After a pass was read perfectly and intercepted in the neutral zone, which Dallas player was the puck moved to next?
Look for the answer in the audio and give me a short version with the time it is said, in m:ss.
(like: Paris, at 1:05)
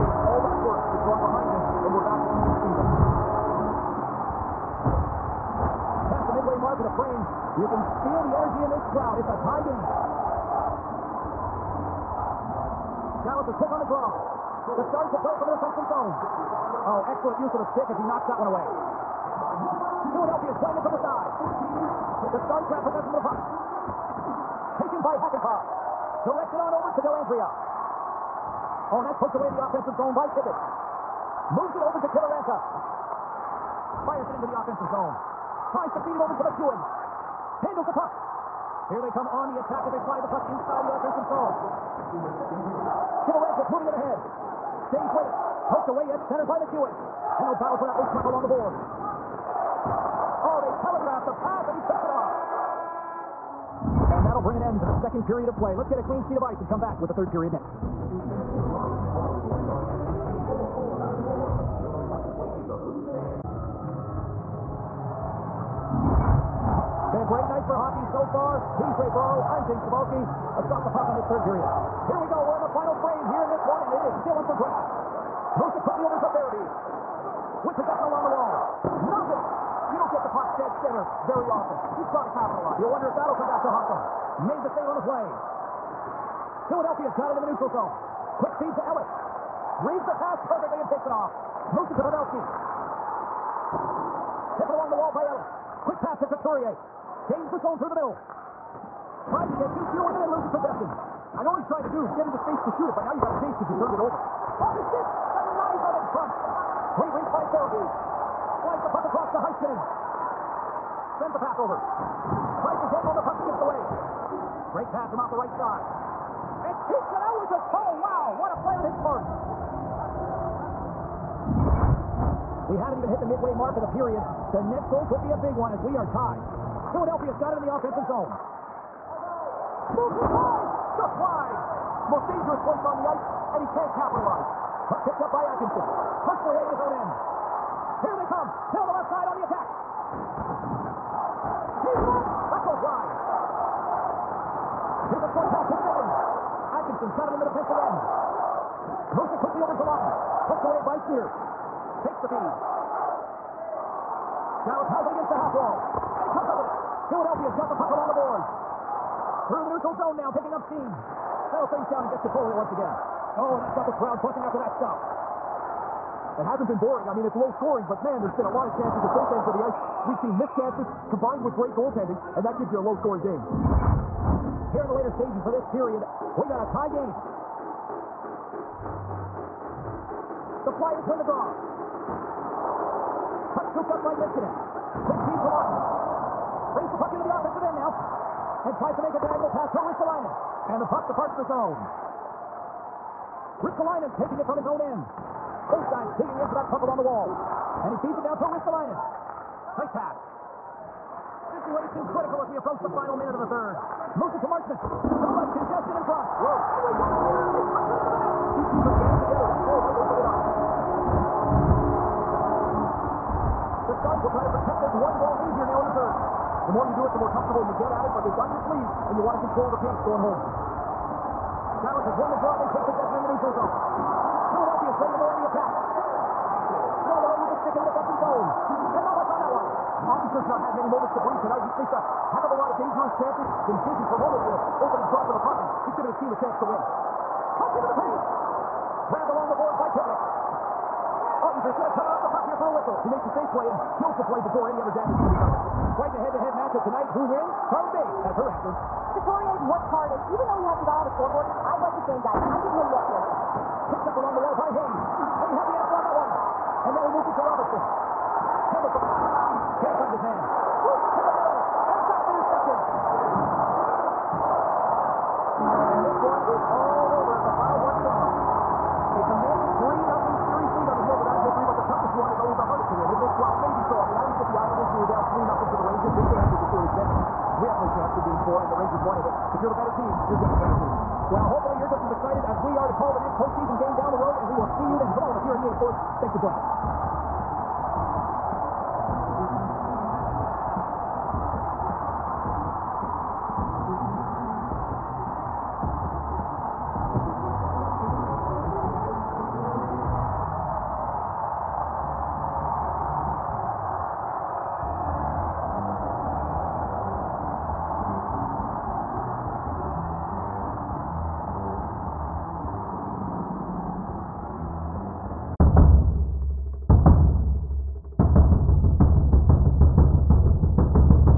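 Pavelski, at 1:32.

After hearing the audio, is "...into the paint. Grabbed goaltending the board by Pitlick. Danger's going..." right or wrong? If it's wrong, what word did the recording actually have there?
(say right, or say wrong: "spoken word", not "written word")
wrong: "along", not "goaltending".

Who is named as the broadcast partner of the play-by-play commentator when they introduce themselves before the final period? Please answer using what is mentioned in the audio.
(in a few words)
Ray Ferraro.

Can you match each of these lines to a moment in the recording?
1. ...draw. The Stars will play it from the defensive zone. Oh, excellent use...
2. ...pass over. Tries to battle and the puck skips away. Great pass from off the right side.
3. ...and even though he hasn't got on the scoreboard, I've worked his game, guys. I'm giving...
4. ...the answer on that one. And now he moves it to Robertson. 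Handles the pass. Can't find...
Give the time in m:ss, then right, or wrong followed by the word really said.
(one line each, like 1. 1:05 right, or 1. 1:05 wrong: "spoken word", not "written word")
1. 0:13 right
2. 1:51 wrong: "dangle", not "battle"
3. 4:10 wrong: "liked", not "worked"
4. 4:15 right.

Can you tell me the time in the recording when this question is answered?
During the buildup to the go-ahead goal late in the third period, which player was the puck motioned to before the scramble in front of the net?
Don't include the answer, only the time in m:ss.
3:24.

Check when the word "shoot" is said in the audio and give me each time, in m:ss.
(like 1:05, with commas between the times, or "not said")
1:42.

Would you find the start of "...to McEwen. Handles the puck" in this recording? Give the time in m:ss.
0:36.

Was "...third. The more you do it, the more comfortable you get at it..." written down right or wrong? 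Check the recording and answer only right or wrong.
right.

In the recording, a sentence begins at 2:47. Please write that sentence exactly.
I mean, it's low scoring, but man, there's been a lot of chances at both ends of the ice.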